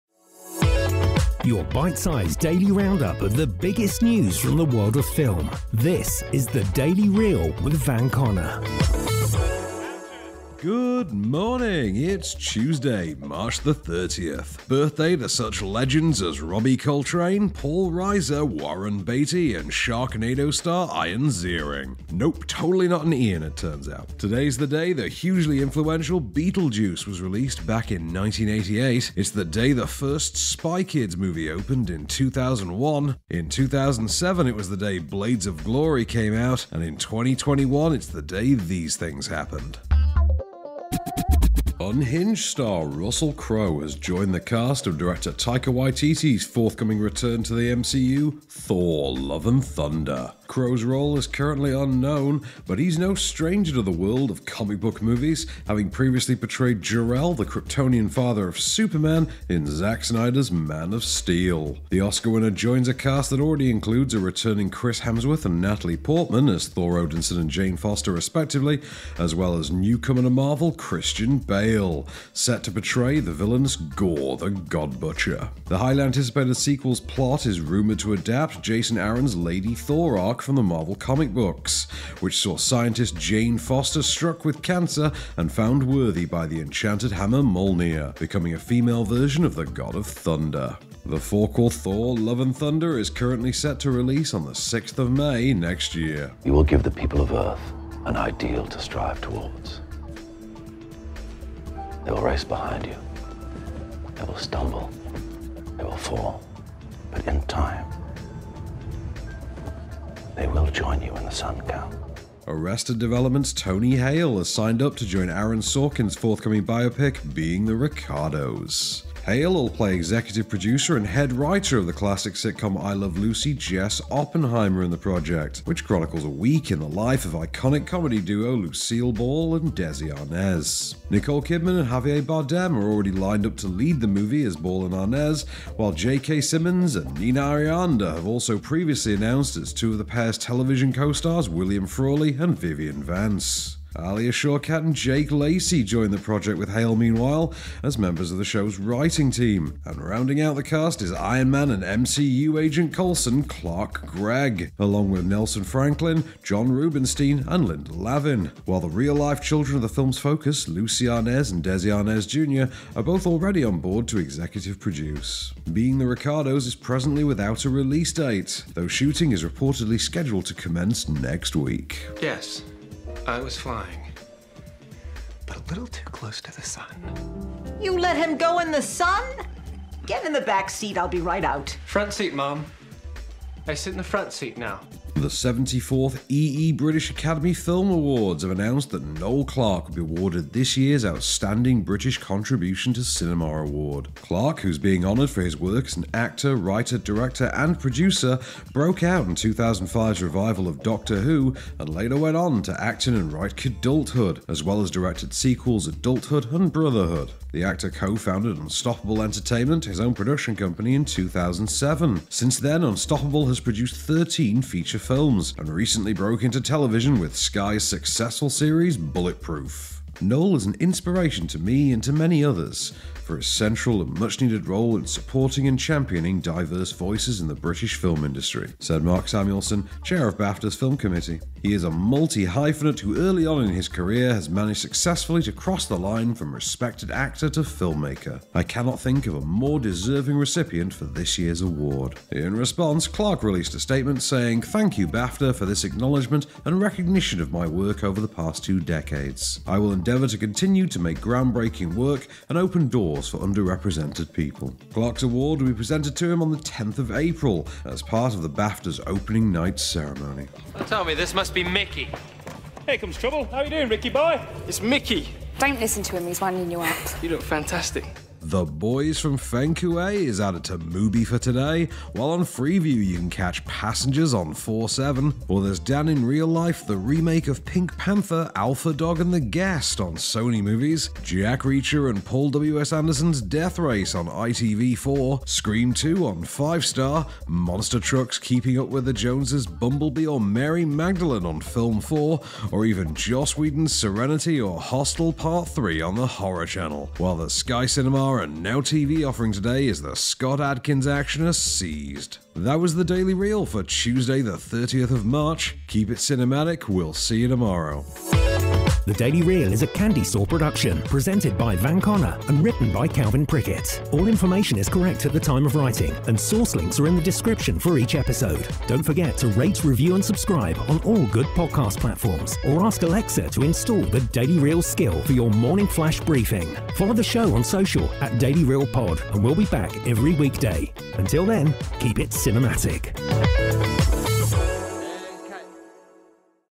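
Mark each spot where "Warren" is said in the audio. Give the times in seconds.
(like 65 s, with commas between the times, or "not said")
18 s.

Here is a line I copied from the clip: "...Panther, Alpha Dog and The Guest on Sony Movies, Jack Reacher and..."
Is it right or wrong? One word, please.
right.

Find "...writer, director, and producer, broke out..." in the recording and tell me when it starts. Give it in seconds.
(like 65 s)
196 s.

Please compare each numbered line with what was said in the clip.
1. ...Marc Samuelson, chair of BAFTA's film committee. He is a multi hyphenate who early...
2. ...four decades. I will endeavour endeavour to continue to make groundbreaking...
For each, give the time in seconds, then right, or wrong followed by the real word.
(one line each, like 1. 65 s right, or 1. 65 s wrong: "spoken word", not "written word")
1. 229 s right
2. 248 s wrong: "two", not "four".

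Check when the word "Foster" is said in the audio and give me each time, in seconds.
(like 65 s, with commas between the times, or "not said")
67 s, 83 s.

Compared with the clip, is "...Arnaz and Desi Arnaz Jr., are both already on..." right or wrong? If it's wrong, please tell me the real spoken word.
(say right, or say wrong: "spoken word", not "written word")
right.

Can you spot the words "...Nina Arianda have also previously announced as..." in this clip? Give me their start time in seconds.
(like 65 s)
137 s.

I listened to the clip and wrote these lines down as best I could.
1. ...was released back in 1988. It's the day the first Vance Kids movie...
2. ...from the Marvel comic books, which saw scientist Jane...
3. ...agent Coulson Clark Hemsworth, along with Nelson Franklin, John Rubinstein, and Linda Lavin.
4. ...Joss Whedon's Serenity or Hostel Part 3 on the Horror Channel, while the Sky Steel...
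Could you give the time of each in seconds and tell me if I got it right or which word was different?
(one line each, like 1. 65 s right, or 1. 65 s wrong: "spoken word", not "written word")
1. 27 s wrong: "Spy", not "Vance"
2. 80 s right
3. 152 s wrong: "Gregg", not "Hemsworth"
4. 293 s wrong: "Cinema", not "Steel".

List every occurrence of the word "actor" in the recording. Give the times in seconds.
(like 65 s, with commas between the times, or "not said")
196 s, 207 s, 237 s.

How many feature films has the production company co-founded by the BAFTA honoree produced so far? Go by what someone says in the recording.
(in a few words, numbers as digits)
13.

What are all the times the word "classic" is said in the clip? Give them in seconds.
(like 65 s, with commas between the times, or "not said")
121 s.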